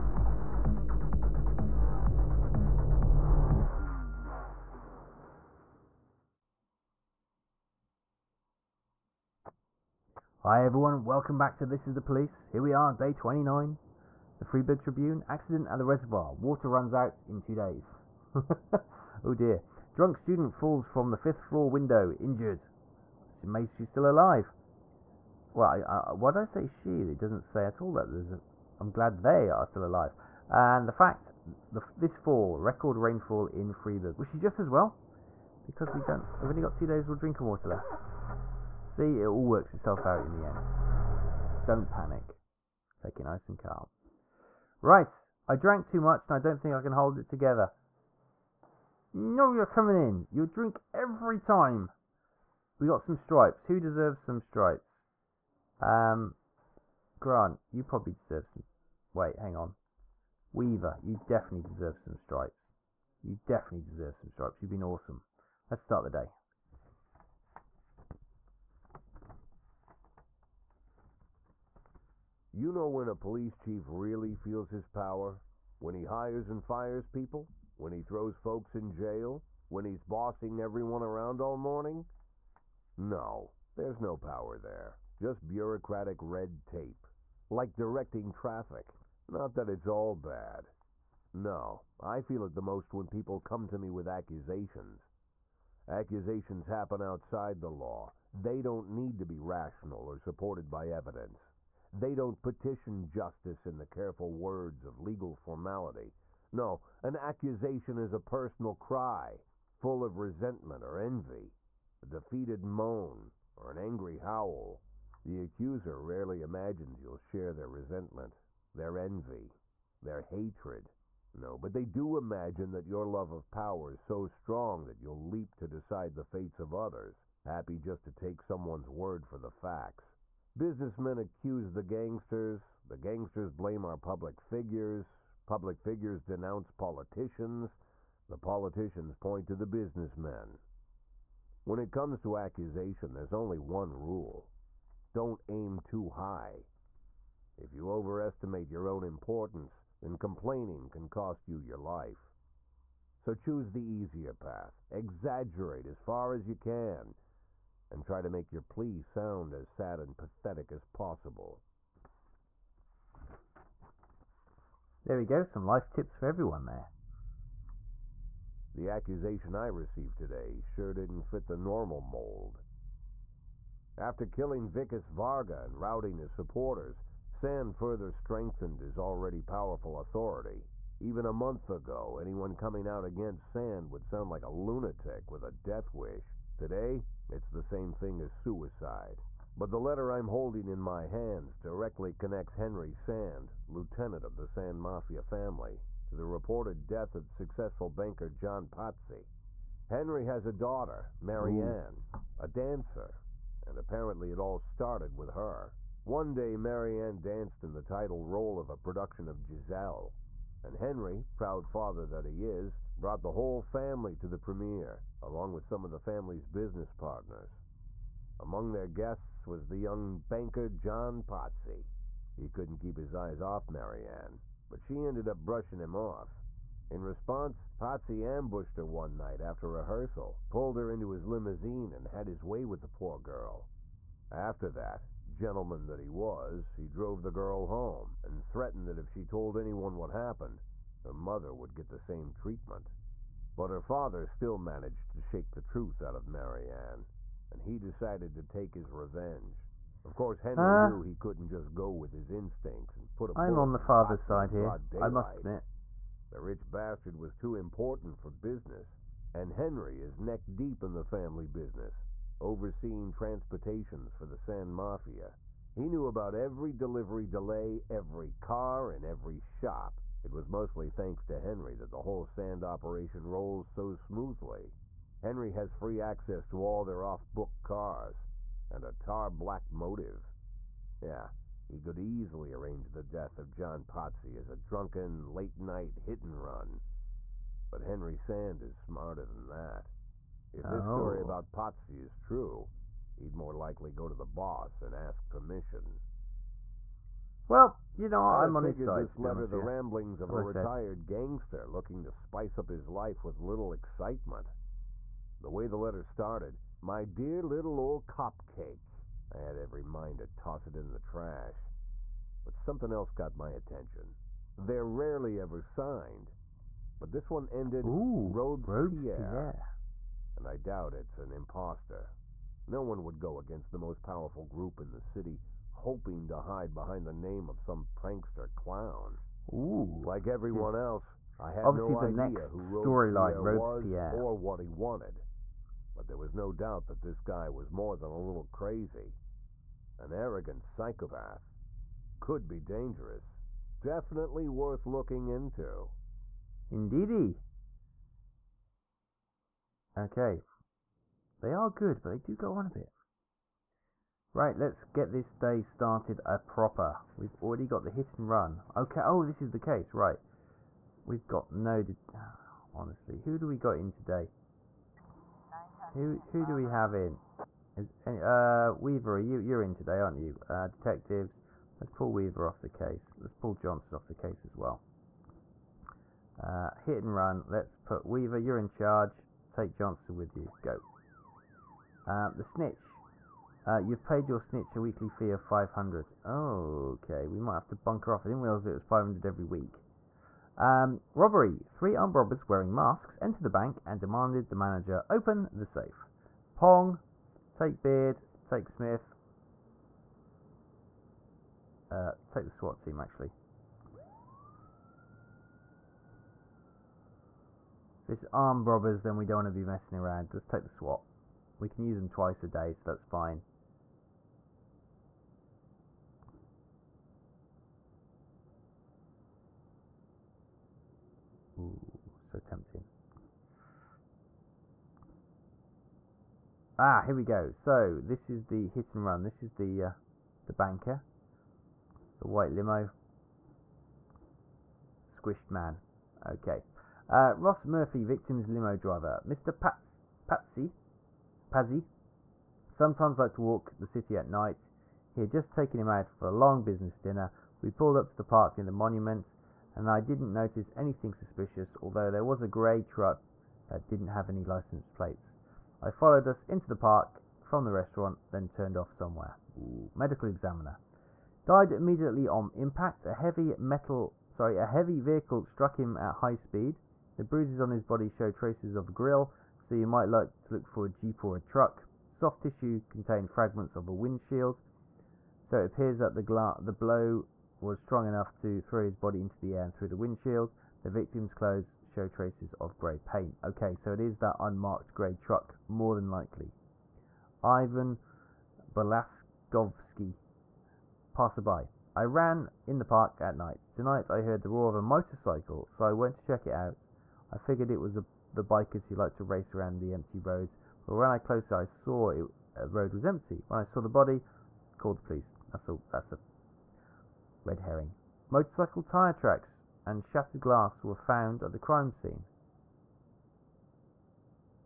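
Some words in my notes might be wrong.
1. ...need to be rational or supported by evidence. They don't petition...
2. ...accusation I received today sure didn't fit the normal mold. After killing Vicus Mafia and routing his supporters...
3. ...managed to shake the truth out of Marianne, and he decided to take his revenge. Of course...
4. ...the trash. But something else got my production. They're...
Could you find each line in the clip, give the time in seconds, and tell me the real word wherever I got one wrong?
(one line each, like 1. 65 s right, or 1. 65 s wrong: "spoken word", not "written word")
1. 98 s right
2. 168 s wrong: "Varga", not "Mafia"
3. 244 s right
4. 310 s wrong: "attention", not "production".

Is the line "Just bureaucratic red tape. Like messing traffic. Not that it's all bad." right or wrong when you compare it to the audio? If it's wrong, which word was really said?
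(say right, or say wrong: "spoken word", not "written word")
wrong: "directing", not "messing".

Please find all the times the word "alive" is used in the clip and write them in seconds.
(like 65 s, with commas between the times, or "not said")
24 s, 29 s.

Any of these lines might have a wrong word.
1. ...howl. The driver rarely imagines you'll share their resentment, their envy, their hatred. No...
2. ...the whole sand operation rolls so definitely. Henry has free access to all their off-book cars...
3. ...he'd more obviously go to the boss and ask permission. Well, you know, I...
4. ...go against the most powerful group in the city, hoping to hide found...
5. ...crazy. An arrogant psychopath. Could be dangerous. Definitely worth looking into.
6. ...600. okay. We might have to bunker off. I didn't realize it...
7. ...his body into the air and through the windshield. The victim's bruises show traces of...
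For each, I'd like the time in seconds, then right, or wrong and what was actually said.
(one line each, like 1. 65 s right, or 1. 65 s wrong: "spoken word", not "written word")
1. 114 s wrong: "accuser", not "driver"
2. 271 s wrong: "smoothly", not "definitely"
3. 293 s wrong: "likely", not "obviously"
4. 323 s wrong: "behind", not "found"
5. 338 s right
6. 385 s wrong: "500", not "600"
7. 478 s wrong: "clothes", not "bruises".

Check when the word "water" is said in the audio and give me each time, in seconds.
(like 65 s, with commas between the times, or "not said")
16 s, 37 s.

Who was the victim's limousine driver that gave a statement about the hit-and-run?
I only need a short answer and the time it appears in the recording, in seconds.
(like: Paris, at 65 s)
Ross Murphy, at 437 s.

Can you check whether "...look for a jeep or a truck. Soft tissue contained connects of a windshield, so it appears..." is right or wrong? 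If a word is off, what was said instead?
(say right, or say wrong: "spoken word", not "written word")
wrong: "fragments", not "connects".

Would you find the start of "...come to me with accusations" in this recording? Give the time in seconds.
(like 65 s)
93 s.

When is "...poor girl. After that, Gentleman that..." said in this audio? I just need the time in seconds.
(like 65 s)
232 s.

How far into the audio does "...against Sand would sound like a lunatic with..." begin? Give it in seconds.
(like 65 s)
183 s.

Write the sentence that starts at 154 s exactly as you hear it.
Exaggerate as far as you can and try to make your plea sound as sad and pathetic as possible.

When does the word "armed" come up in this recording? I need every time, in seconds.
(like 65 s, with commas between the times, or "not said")
391 s, 408 s.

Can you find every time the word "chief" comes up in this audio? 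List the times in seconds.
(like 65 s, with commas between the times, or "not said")
73 s.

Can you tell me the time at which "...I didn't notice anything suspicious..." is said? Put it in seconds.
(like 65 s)
449 s.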